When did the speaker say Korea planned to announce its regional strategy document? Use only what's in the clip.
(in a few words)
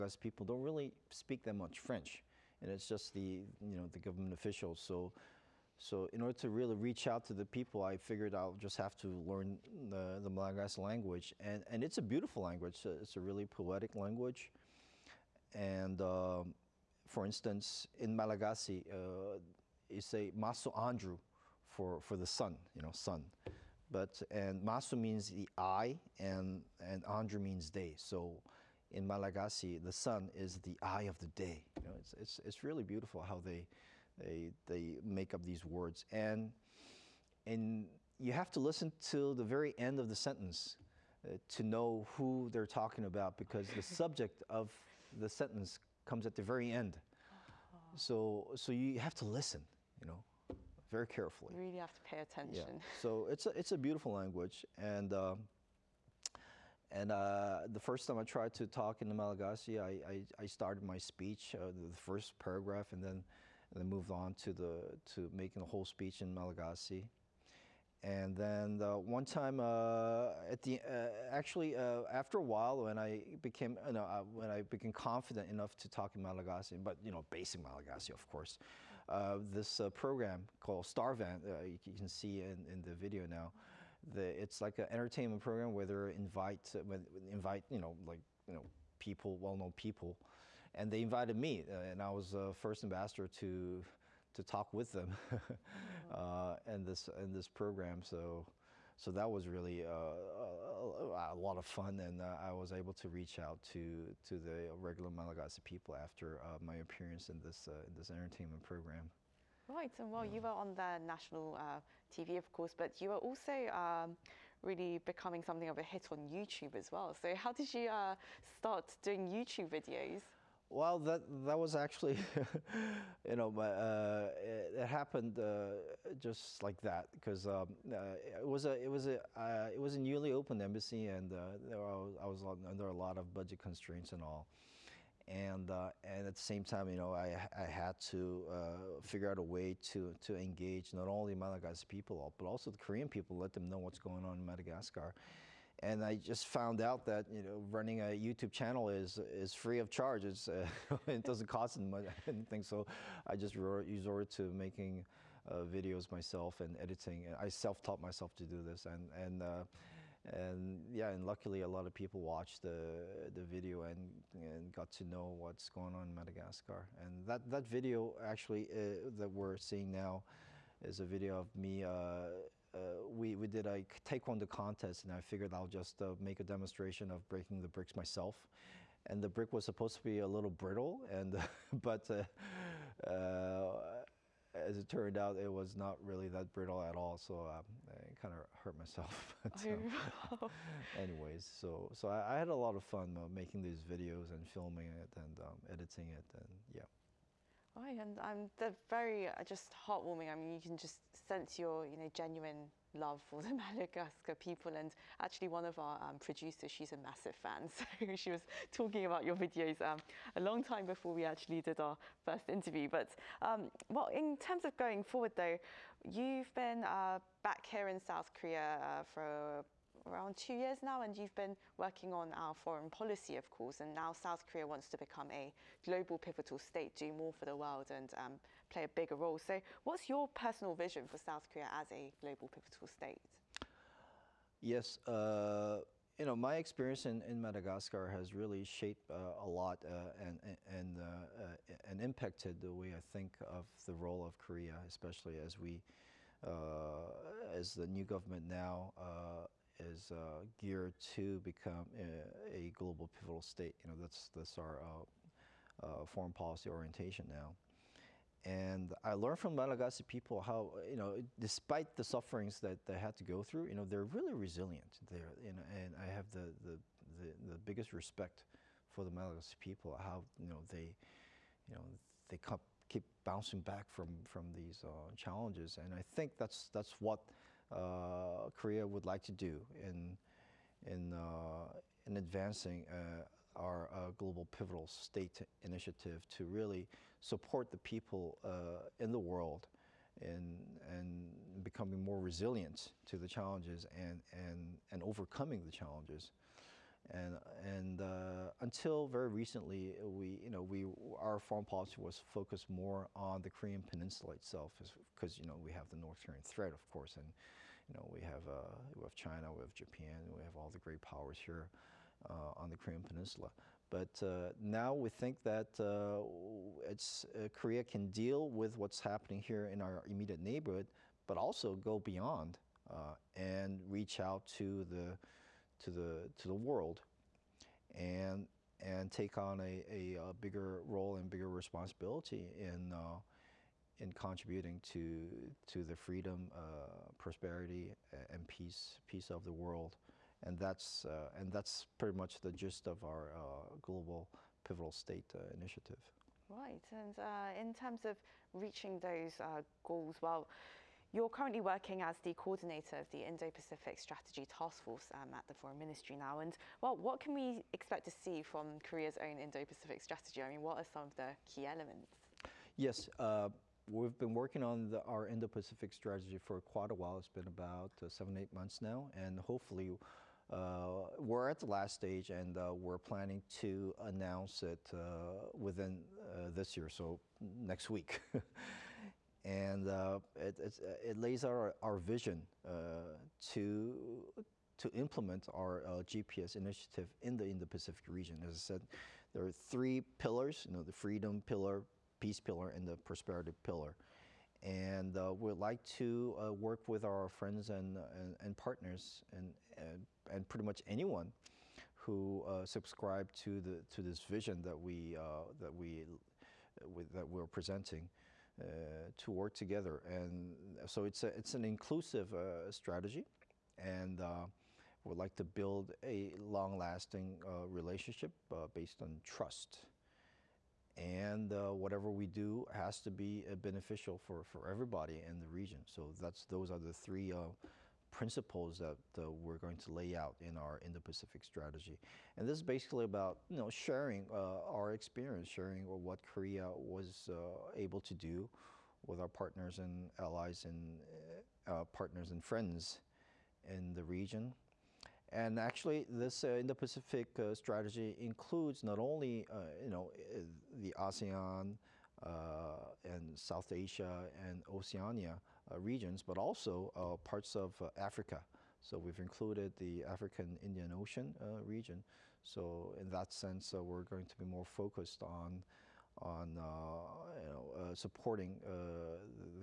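next week.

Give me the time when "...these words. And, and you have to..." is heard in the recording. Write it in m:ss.
0:35.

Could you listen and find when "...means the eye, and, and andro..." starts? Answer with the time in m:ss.
0:24.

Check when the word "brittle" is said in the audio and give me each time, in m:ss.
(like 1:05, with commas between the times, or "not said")
3:00, 3:06.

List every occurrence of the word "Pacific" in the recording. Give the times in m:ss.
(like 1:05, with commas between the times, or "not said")
5:53, 5:59, 6:05, 6:27, 7:10, 7:26.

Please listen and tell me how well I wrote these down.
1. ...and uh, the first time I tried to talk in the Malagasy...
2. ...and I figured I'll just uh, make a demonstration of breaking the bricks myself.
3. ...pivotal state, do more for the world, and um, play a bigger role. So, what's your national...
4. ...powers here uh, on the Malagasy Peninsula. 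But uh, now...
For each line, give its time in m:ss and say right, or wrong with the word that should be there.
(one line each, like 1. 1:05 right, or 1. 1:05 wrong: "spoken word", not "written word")
1. 0:56 right
2. 2:55 right
3. 3:46 wrong: "personal", not "national"
4. 5:11 wrong: "Korean", not "Malagasy".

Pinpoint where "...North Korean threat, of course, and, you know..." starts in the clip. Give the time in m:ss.
5:05.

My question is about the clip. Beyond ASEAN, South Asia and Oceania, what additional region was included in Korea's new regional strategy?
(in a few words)
African Indian Ocean region.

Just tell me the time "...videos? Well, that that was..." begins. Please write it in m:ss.
1:59.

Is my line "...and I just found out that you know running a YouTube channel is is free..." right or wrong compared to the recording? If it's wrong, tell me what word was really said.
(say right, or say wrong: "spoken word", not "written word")
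right.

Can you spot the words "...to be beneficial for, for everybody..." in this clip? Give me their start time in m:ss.
7:03.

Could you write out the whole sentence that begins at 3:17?
Right, and I'm they're very uh, just heartwarming.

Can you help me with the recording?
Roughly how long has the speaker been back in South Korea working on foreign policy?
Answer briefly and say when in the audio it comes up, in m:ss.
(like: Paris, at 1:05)
2 years, at 3:40.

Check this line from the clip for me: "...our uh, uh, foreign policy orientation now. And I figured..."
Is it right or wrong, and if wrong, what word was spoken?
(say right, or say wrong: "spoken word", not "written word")
wrong: "learned", not "figured".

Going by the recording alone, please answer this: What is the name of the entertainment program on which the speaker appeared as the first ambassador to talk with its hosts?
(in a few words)
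Starvent.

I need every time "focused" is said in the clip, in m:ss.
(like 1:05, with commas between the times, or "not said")
5:02, 7:44.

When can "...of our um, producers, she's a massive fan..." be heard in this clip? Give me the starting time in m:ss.
3:25.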